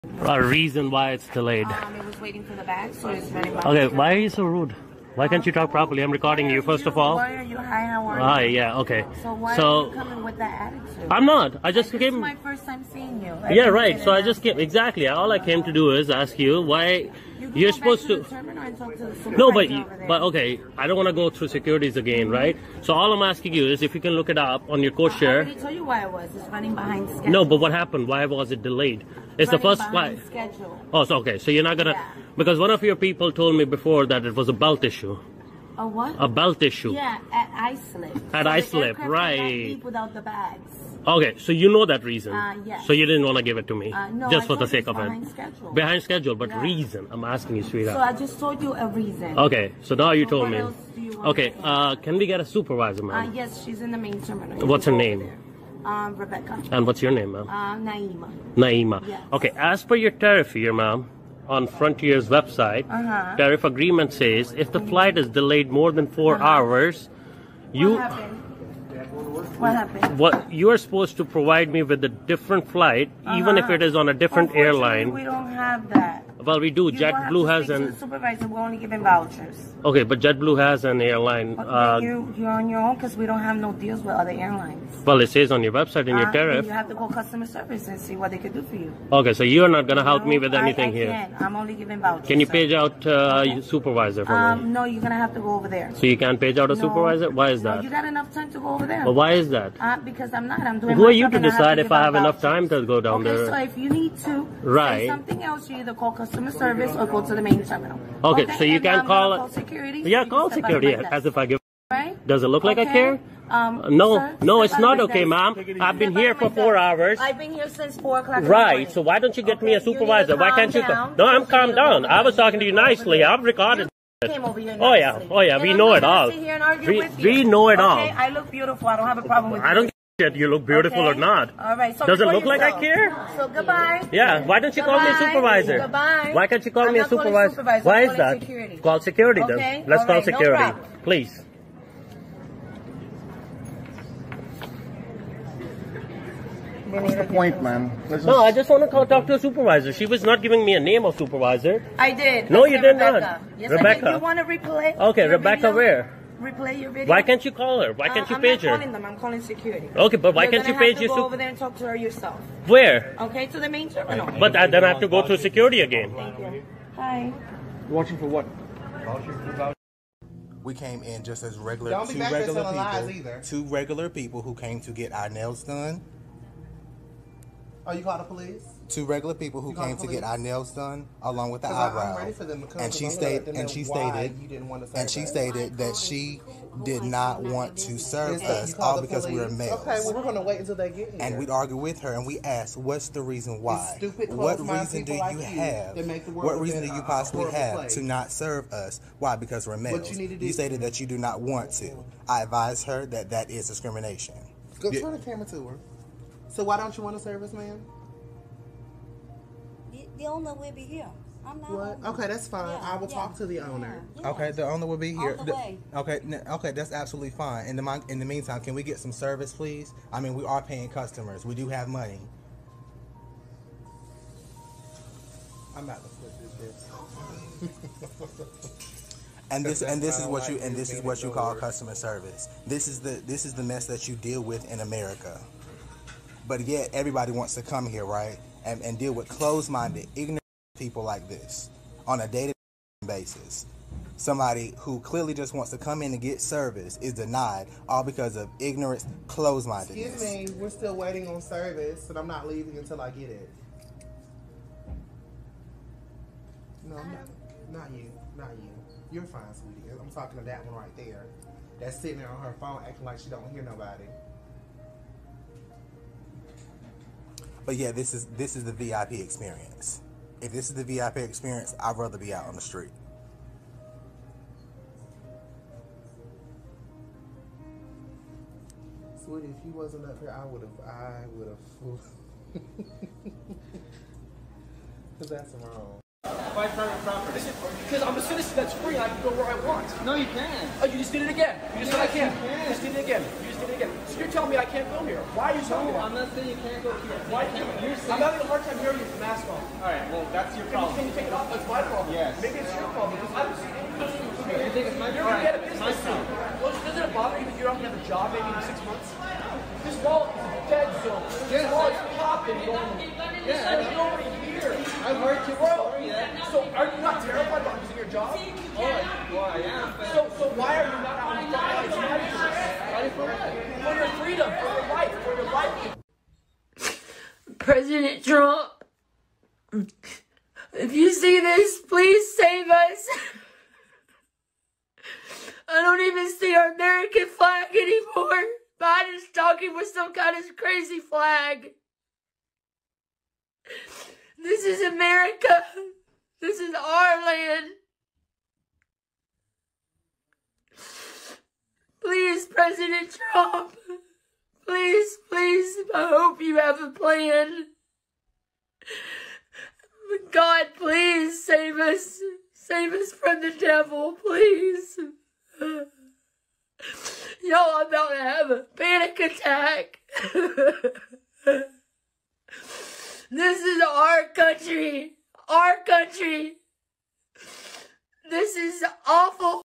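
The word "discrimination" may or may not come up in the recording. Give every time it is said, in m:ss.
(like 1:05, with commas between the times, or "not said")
3:23.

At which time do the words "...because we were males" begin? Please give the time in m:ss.
3:09.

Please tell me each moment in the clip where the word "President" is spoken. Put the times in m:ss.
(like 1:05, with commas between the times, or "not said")
5:27, 5:52.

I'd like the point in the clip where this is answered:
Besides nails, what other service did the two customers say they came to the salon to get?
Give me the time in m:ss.
3:01.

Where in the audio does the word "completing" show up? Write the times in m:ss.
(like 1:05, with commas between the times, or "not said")
not said.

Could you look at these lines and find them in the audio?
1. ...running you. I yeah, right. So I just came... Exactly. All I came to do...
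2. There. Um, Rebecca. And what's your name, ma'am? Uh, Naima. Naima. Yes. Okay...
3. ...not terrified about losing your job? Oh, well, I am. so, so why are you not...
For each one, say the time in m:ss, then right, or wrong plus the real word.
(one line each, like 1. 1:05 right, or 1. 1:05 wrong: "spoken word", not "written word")
1. 0:12 wrong: "seeing", not "running"
2. 0:55 right
3. 5:17 right.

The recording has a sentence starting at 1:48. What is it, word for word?
Okay, okay so you can um, call, call, security.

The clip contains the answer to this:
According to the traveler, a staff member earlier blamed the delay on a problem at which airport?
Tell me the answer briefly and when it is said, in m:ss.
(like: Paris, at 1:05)
Islip, at 0:38.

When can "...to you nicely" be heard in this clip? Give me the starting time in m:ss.
2:02.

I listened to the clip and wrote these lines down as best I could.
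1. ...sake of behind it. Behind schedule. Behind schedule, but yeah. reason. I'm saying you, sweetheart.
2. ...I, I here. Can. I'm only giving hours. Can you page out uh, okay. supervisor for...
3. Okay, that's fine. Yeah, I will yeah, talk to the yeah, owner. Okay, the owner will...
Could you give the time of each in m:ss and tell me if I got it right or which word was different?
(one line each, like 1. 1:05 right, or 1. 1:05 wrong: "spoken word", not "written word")
1. 0:44 wrong: "asking", not "saying"
2. 1:30 wrong: "vouchers", not "hours"
3. 3:32 right.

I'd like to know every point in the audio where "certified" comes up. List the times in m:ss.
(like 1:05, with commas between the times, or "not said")
not said.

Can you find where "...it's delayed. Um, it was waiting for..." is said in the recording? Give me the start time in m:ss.
0:01.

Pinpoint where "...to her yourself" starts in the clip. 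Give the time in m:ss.
2:41.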